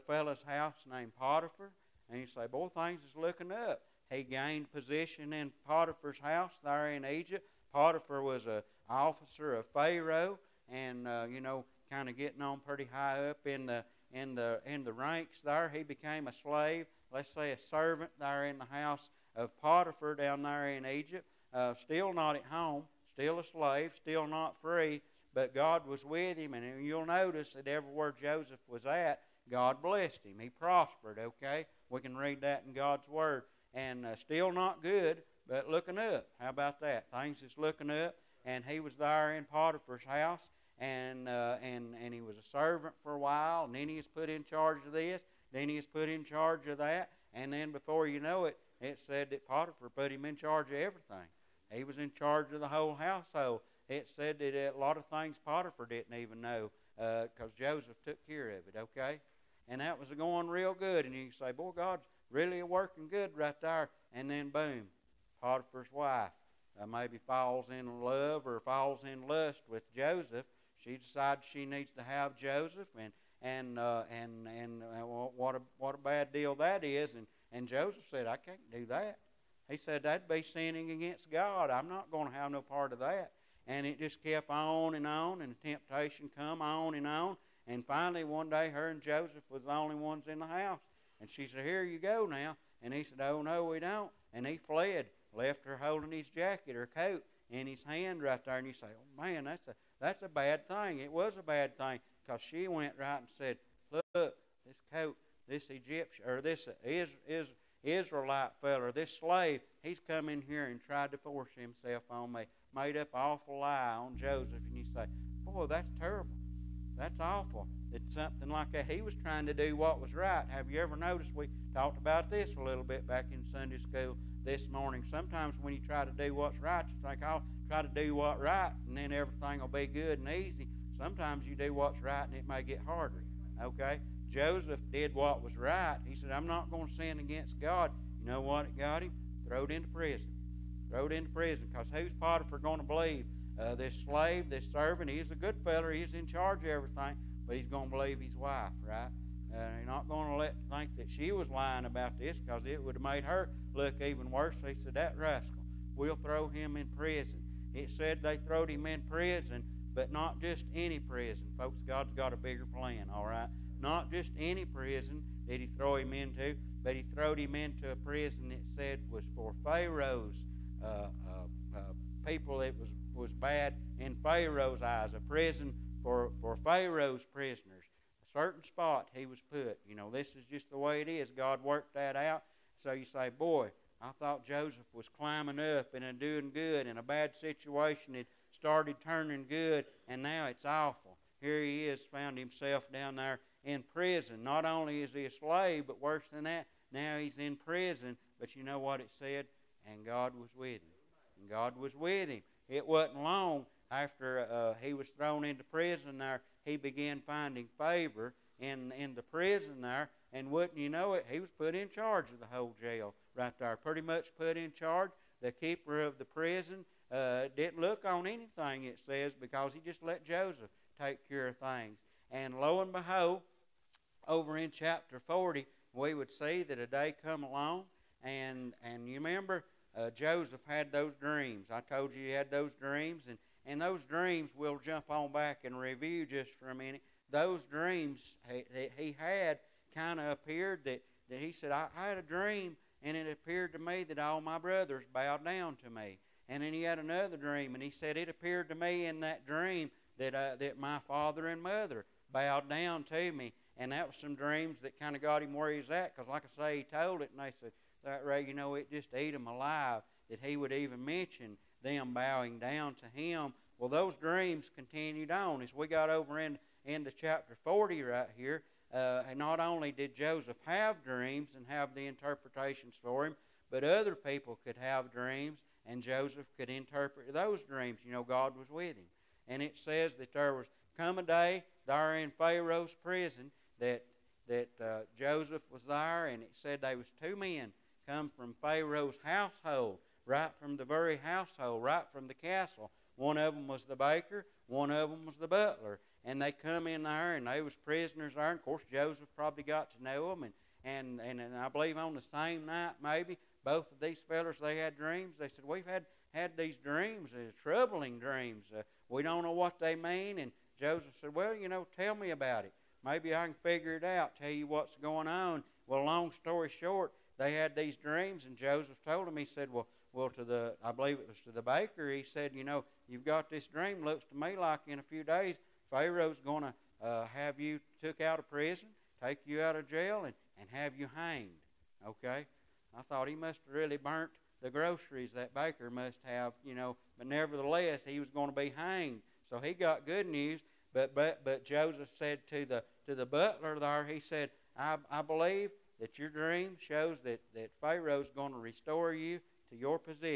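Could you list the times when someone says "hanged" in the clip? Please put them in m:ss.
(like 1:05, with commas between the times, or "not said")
5:31, 5:38.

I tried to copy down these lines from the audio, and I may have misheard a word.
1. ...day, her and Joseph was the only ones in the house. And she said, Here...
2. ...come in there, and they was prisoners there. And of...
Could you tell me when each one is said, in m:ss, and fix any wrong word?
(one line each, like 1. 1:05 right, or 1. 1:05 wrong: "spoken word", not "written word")
1. 1:28 right
2. 4:56 right.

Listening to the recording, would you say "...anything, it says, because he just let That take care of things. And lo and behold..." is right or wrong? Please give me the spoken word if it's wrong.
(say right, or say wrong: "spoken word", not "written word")
wrong: "Joseph", not "That".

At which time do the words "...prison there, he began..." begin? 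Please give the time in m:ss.
3:25.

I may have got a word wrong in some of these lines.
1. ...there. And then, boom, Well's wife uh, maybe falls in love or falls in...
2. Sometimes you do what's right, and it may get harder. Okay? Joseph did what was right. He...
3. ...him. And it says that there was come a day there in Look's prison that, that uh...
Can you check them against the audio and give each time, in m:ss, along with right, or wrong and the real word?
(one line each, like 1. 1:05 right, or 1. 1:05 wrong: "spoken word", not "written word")
1. 1:03 wrong: "Potiphar", not "Well"
2. 2:11 right
3. 4:38 wrong: "Pharaoh", not "Look".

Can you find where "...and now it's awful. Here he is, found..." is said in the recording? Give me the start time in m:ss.
3:10.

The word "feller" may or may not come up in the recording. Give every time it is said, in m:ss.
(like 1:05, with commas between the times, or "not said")
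1:48, 2:25, 5:04.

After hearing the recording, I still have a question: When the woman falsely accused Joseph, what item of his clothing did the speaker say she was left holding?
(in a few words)
jacket or coat.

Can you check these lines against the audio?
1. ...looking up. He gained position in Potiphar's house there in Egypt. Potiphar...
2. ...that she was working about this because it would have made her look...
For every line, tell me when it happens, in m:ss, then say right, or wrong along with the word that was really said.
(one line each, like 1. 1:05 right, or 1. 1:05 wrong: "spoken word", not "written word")
1. 0:03 right
2. 2:30 wrong: "lying", not "working".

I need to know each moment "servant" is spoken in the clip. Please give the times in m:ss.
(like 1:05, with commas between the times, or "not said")
0:17, 0:42, 2:24.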